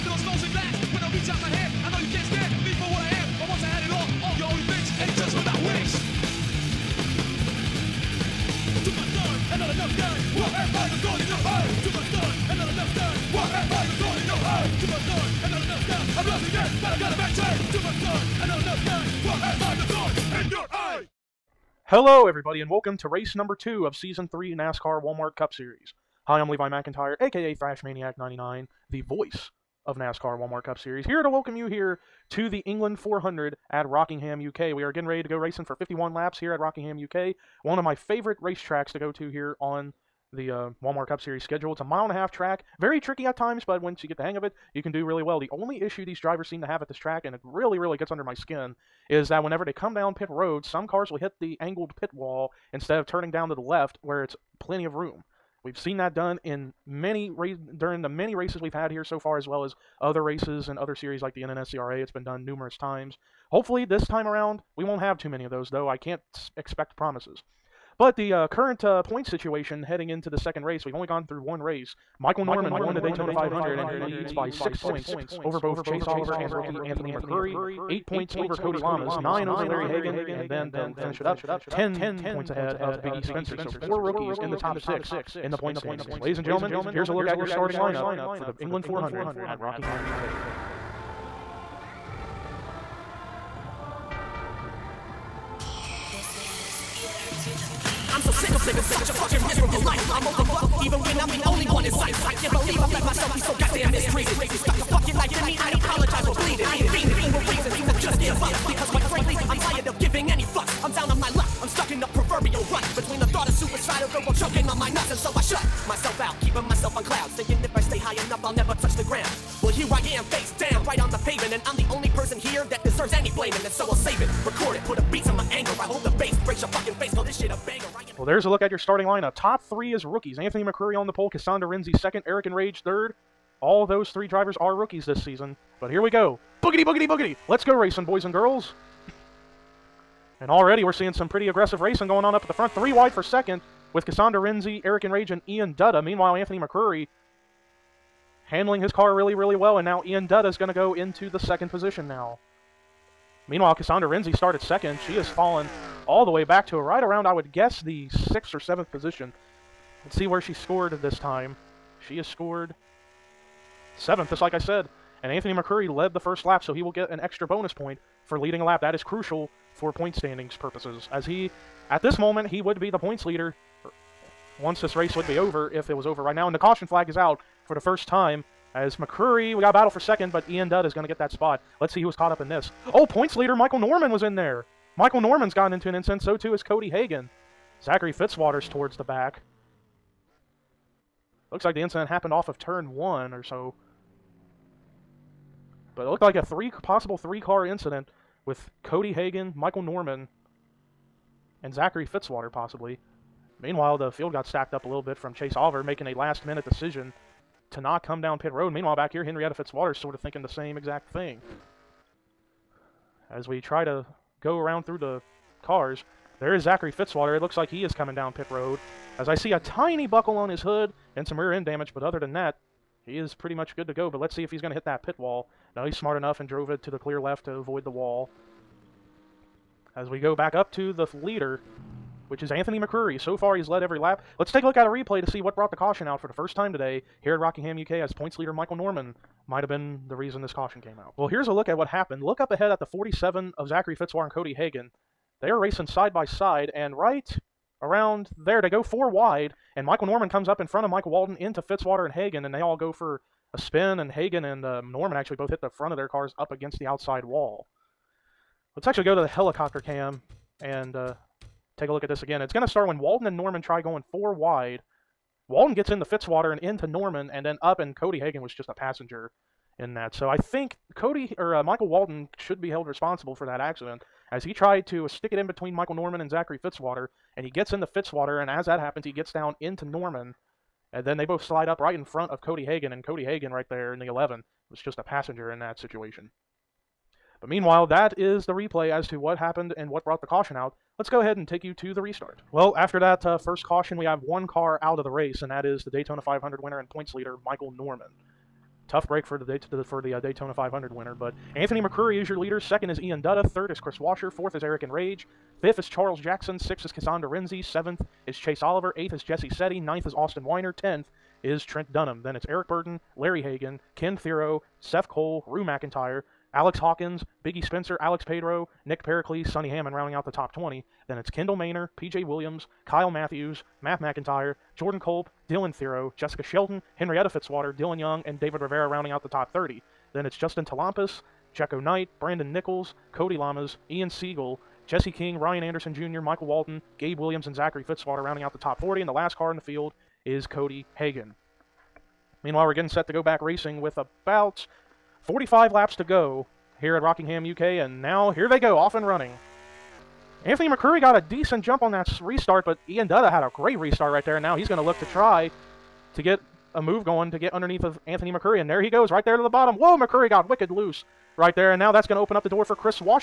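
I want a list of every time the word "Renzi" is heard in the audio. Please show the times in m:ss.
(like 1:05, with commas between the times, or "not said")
2:11, 2:24, 2:34, 5:07.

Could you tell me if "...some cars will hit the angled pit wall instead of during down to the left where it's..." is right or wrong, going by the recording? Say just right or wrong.
wrong.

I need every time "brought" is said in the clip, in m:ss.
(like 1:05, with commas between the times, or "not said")
3:55, 4:50.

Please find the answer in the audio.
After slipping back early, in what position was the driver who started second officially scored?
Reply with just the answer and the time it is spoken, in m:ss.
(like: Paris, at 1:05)
7th, at 2:42.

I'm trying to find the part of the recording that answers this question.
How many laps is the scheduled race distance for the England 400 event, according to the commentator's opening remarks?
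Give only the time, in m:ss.
0:35.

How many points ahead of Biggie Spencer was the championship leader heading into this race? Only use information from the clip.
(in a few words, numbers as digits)
10.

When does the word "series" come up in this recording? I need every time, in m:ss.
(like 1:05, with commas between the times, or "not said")
0:25, 0:30, 0:41, 1:00.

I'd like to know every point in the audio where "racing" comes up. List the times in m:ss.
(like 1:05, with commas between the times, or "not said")
0:35, 2:17, 2:21, 4:05, 5:43.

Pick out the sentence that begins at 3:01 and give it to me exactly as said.
Let's see who is caught up in this.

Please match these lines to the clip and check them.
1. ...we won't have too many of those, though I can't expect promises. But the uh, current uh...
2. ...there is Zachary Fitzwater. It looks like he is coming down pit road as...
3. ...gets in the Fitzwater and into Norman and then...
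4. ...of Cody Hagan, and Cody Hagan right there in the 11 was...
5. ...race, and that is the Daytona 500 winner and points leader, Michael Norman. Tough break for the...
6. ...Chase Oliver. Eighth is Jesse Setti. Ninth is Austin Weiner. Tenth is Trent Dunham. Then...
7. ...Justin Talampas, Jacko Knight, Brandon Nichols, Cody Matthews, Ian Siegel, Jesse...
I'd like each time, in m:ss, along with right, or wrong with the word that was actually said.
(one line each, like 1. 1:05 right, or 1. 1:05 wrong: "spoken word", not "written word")
1. 1:04 right
2. 3:36 right
3. 4:25 right
4. 4:42 right
5. 4:55 right
6. 5:08 right
7. 5:30 wrong: "Lamas", not "Matthews".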